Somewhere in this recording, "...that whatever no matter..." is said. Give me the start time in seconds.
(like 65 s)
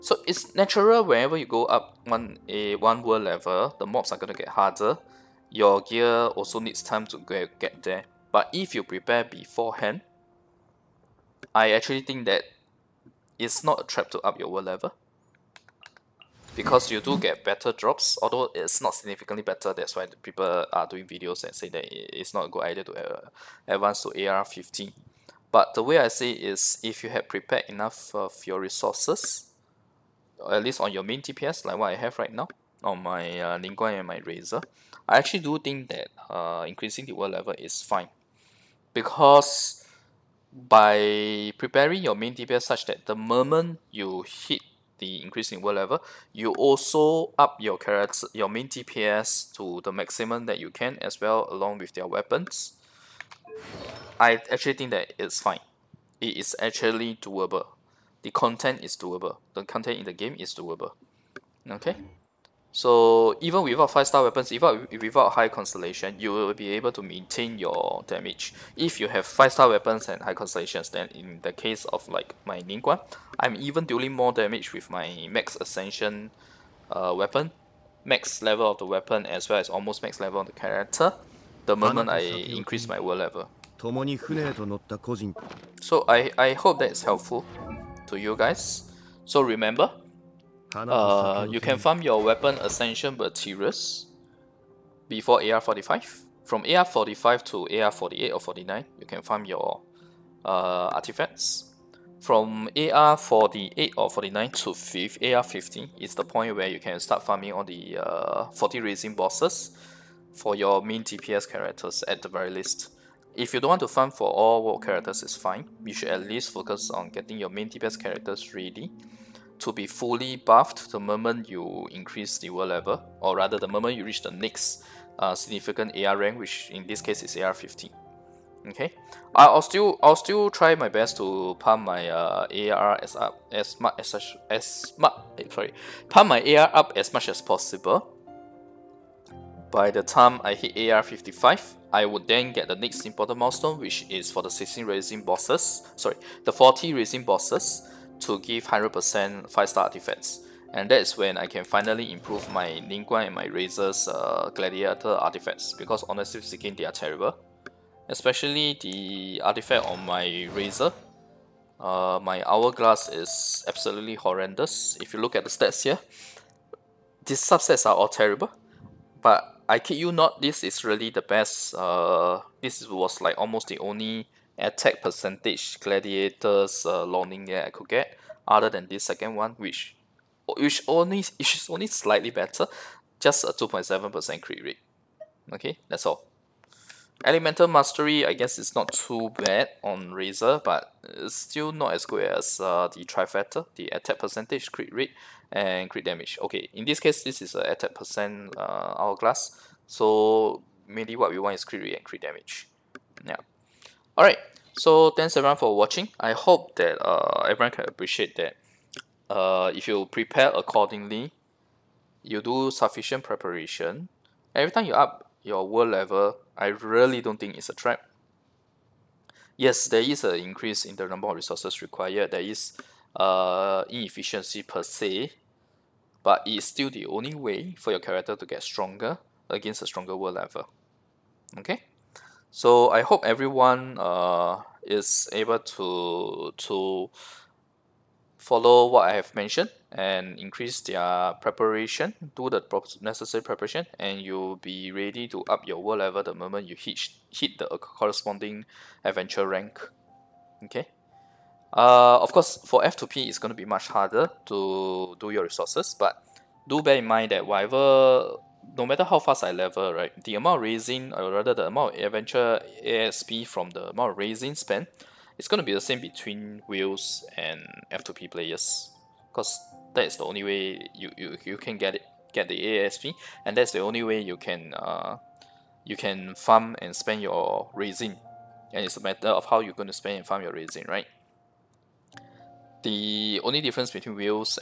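257 s.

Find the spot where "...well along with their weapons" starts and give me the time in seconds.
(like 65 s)
51 s.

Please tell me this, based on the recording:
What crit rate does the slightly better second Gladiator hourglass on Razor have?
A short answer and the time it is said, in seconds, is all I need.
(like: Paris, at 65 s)
2.7%, at 183 s.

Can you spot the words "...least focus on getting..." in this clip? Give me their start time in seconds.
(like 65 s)
116 s.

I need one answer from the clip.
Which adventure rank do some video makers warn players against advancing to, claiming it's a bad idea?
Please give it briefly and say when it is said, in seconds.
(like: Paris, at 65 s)
AR15, at 24 s.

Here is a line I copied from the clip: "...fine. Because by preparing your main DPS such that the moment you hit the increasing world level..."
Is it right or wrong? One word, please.
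right.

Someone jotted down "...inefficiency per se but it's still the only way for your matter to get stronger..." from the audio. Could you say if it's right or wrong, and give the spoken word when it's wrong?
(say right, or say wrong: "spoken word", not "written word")
wrong: "character", not "matter".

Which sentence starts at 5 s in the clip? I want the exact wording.
Your gear also needs time to get, get there.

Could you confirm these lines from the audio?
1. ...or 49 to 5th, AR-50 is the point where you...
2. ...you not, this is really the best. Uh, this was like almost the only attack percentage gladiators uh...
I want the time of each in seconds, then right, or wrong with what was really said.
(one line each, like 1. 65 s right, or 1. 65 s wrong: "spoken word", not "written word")
1. 103 s right
2. 169 s right.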